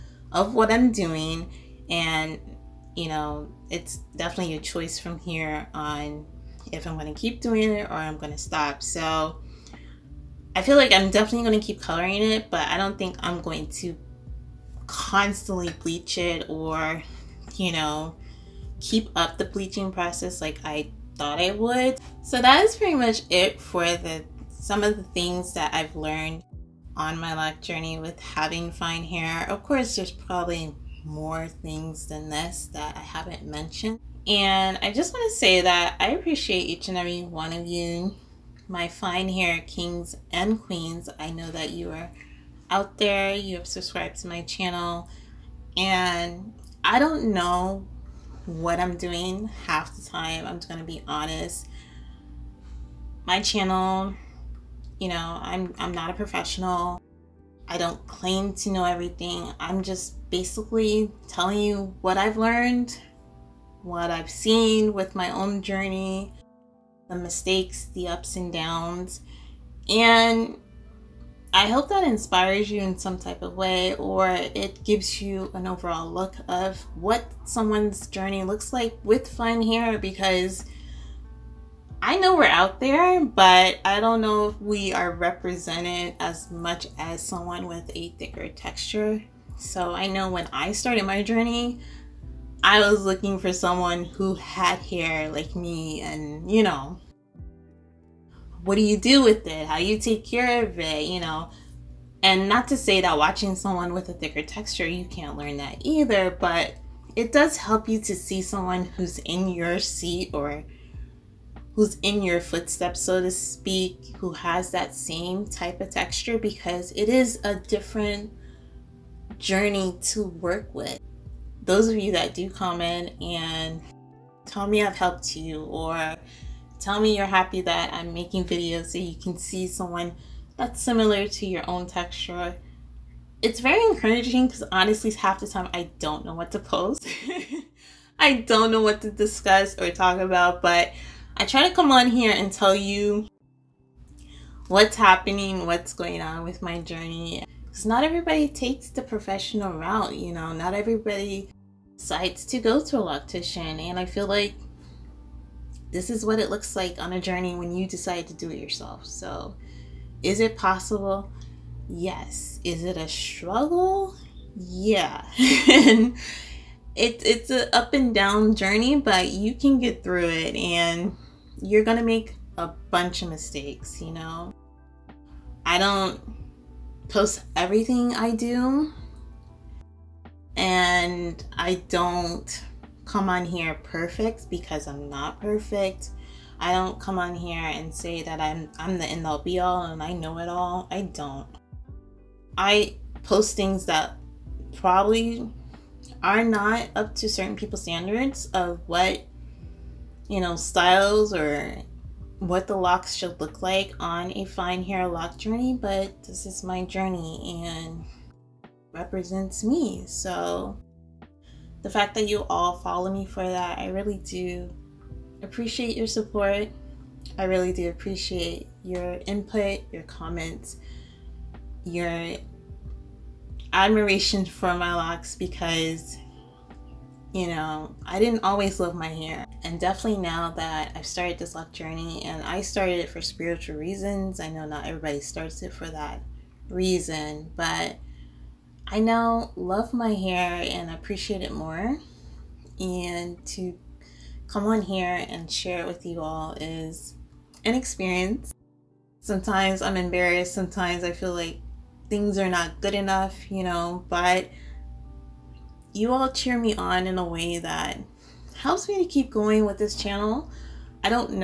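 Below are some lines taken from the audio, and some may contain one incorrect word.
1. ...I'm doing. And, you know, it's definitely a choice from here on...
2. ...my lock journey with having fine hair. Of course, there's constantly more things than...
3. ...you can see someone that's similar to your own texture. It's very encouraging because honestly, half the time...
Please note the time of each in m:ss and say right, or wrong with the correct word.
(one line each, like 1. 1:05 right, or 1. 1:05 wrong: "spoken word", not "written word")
1. 0:00 right
2. 0:27 wrong: "probably", not "constantly"
3. 2:08 right.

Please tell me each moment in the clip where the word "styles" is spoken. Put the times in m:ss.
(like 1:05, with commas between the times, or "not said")
3:20.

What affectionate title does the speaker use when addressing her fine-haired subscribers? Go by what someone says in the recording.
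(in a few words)
fine hair kings and queens.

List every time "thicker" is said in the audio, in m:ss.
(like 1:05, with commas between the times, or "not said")
1:28, 1:44.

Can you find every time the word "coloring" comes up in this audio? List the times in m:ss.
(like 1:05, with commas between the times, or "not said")
0:11.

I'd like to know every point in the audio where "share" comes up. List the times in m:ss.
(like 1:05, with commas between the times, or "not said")
4:05.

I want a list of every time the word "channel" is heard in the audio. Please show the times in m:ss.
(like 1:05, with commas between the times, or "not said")
0:44, 0:53, 4:19.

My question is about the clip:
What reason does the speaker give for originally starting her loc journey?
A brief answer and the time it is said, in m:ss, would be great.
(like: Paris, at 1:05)
spiritual reasons, at 3:53.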